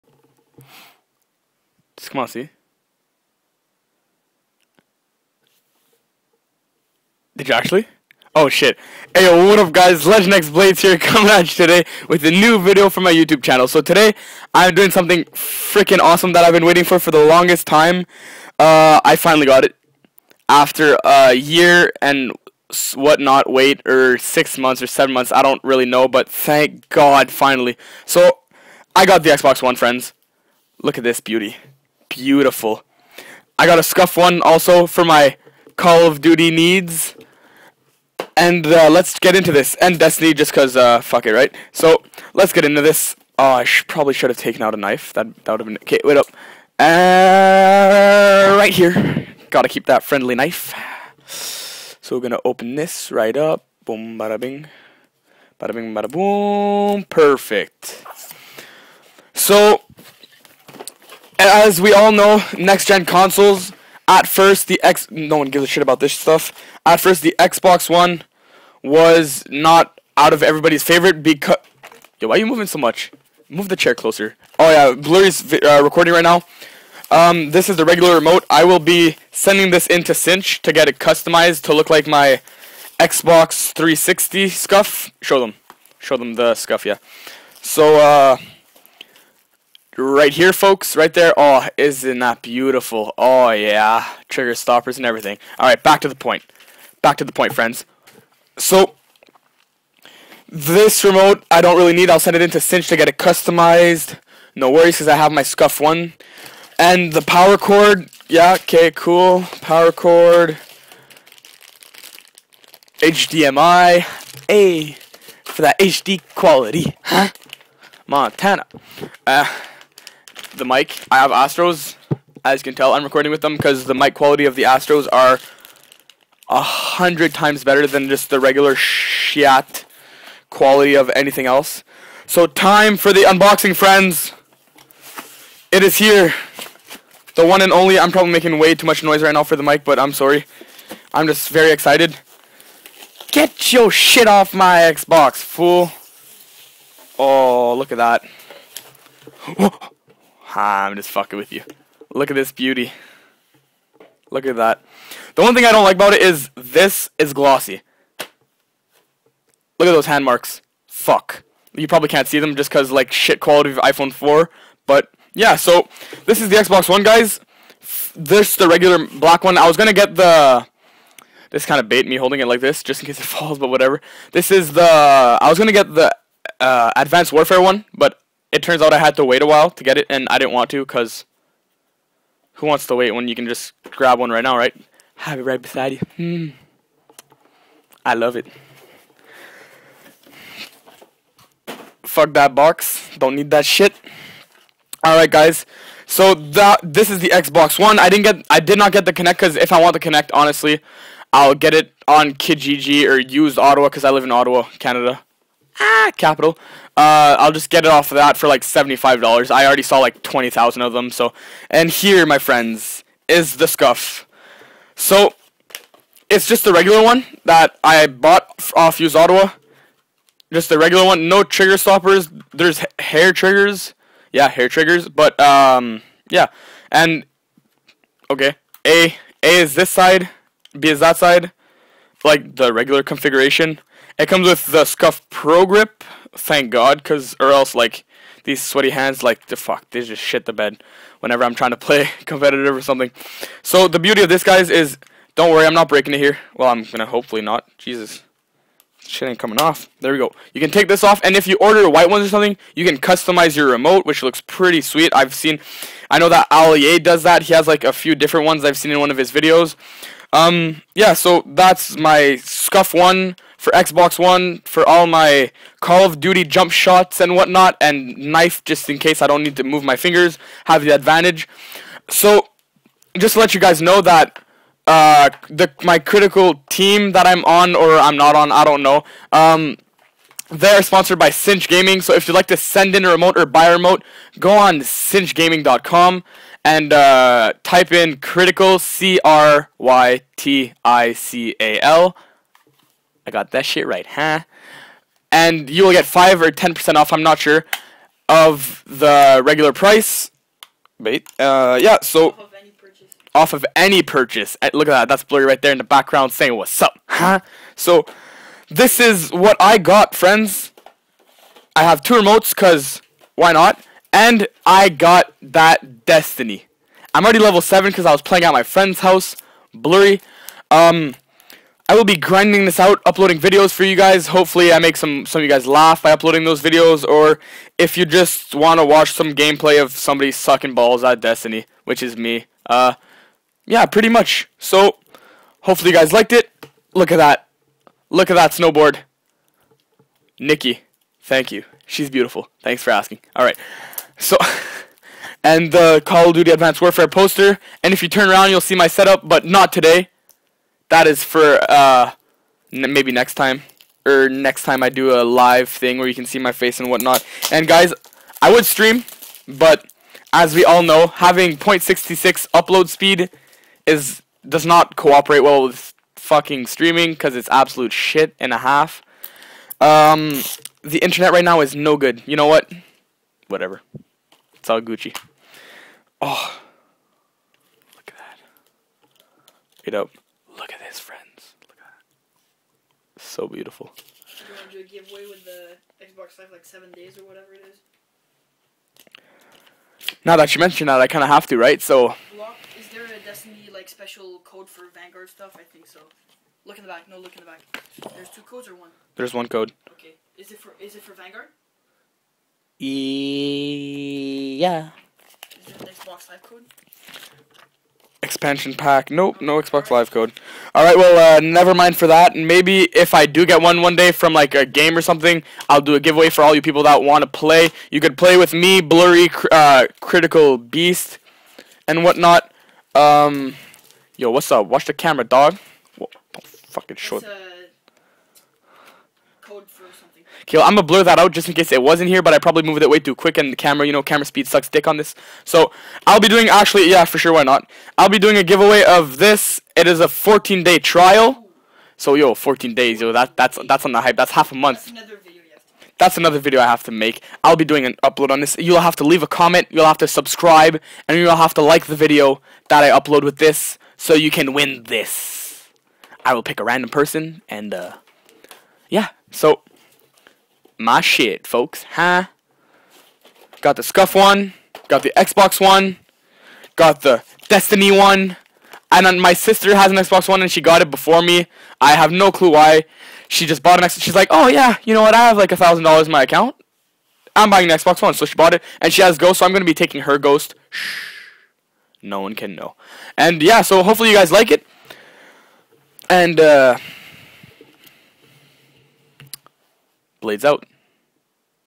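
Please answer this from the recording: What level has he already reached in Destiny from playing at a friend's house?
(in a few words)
7.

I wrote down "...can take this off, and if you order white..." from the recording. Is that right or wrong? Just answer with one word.
right.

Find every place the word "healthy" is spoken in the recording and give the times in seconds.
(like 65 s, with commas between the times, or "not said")
not said.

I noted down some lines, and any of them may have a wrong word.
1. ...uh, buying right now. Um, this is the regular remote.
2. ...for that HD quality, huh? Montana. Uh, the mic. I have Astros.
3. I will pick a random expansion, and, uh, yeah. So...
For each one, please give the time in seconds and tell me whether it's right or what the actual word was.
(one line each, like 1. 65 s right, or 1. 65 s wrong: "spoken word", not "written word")
1. 75 s wrong: "recording", not "buying"
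2. 115 s right
3. 456 s wrong: "person", not "expansion".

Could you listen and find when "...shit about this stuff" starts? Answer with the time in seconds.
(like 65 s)
65 s.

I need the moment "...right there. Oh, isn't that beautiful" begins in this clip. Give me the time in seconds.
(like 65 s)
90 s.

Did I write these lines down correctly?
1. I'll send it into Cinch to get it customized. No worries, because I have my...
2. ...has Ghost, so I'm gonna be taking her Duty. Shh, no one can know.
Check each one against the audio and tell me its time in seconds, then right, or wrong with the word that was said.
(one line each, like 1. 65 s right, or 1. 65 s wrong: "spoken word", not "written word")
1. 102 s right
2. 479 s wrong: "Ghost", not "Duty".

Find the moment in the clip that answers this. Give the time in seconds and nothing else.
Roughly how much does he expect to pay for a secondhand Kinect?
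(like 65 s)
208 s.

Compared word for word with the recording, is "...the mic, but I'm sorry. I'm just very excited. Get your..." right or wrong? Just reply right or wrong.
right.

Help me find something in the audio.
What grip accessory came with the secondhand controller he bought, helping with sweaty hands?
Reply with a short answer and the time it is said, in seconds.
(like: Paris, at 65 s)
Scuf Pro Grip, at 234 s.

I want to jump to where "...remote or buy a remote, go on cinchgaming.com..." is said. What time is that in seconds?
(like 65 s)
283 s.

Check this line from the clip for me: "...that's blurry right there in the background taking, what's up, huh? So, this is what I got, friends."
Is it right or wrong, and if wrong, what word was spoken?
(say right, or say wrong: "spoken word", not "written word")
wrong: "saying", not "taking".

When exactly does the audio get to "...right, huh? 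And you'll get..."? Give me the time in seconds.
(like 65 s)
293 s.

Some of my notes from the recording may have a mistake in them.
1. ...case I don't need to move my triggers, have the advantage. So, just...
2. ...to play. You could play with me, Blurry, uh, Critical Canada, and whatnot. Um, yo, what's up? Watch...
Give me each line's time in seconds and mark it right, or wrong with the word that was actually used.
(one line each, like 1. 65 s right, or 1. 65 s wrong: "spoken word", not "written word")
1. 268 s wrong: "fingers", not "triggers"
2. 417 s wrong: "Beast", not "Canada".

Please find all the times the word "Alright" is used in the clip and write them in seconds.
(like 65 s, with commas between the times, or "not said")
195 s, 343 s.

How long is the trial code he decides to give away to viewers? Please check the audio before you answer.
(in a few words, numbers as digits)
14 days.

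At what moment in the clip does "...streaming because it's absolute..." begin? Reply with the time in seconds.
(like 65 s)
366 s.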